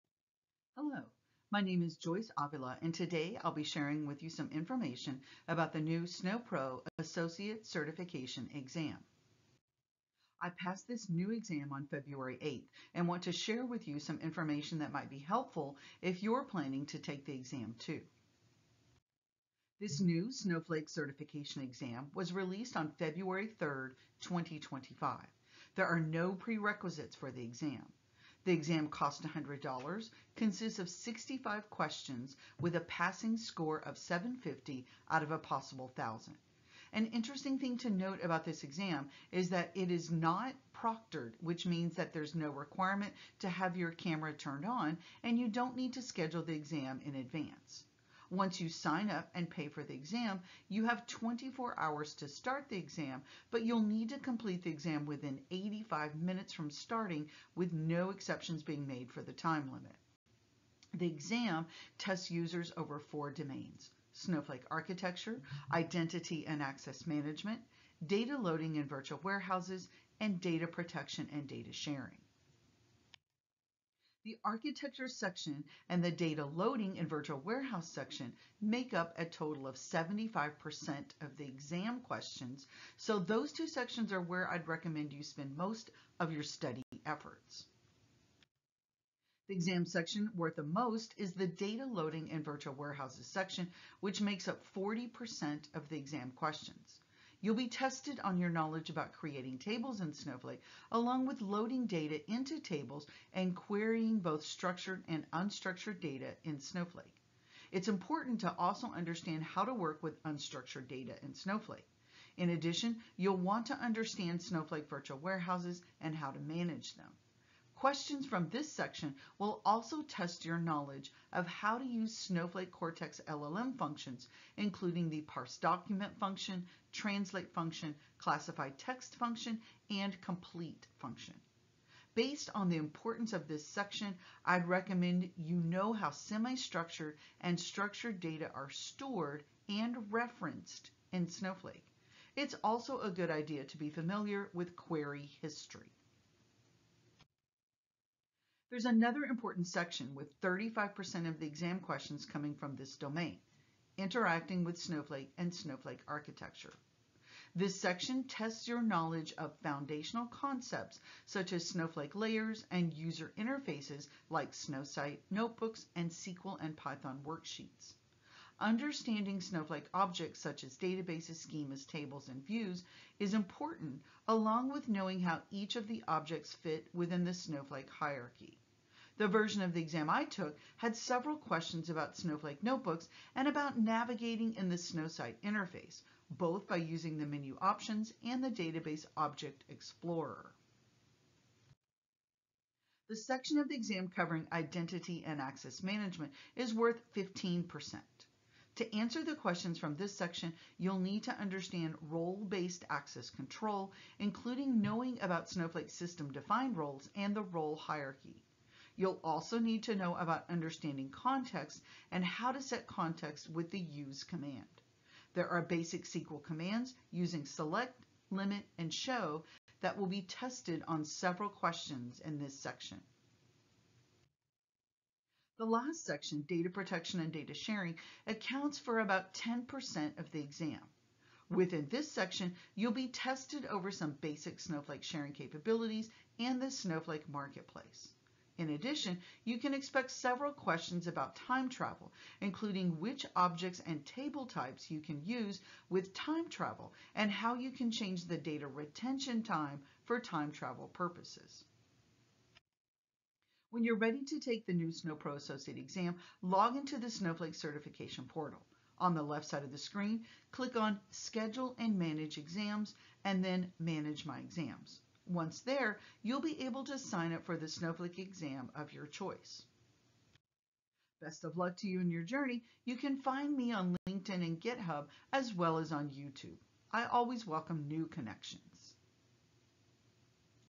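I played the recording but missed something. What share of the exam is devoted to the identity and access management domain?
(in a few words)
15%.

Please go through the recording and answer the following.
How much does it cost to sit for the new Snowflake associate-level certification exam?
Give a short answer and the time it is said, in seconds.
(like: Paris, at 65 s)
$100, at 29 s.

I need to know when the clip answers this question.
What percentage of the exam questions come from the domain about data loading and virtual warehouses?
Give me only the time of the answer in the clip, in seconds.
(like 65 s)
94 s.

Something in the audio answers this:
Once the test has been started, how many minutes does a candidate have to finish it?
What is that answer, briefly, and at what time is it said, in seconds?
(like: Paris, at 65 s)
85, at 55 s.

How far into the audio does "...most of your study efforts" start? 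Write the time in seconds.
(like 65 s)
85 s.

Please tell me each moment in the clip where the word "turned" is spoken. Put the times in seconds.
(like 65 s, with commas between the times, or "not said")
44 s.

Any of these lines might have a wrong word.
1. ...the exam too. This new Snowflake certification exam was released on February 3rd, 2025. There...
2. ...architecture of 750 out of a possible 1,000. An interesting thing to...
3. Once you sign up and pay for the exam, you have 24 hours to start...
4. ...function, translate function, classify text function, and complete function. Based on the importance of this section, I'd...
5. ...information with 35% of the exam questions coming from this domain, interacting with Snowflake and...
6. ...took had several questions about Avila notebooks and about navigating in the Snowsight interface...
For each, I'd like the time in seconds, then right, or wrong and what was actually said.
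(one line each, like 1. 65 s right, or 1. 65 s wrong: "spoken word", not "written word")
1. 17 s right
2. 33 s wrong: "score", not "architecture"
3. 48 s right
4. 126 s right
5. 149 s wrong: "section", not "information"
6. 180 s wrong: "Snowflake", not "Avila".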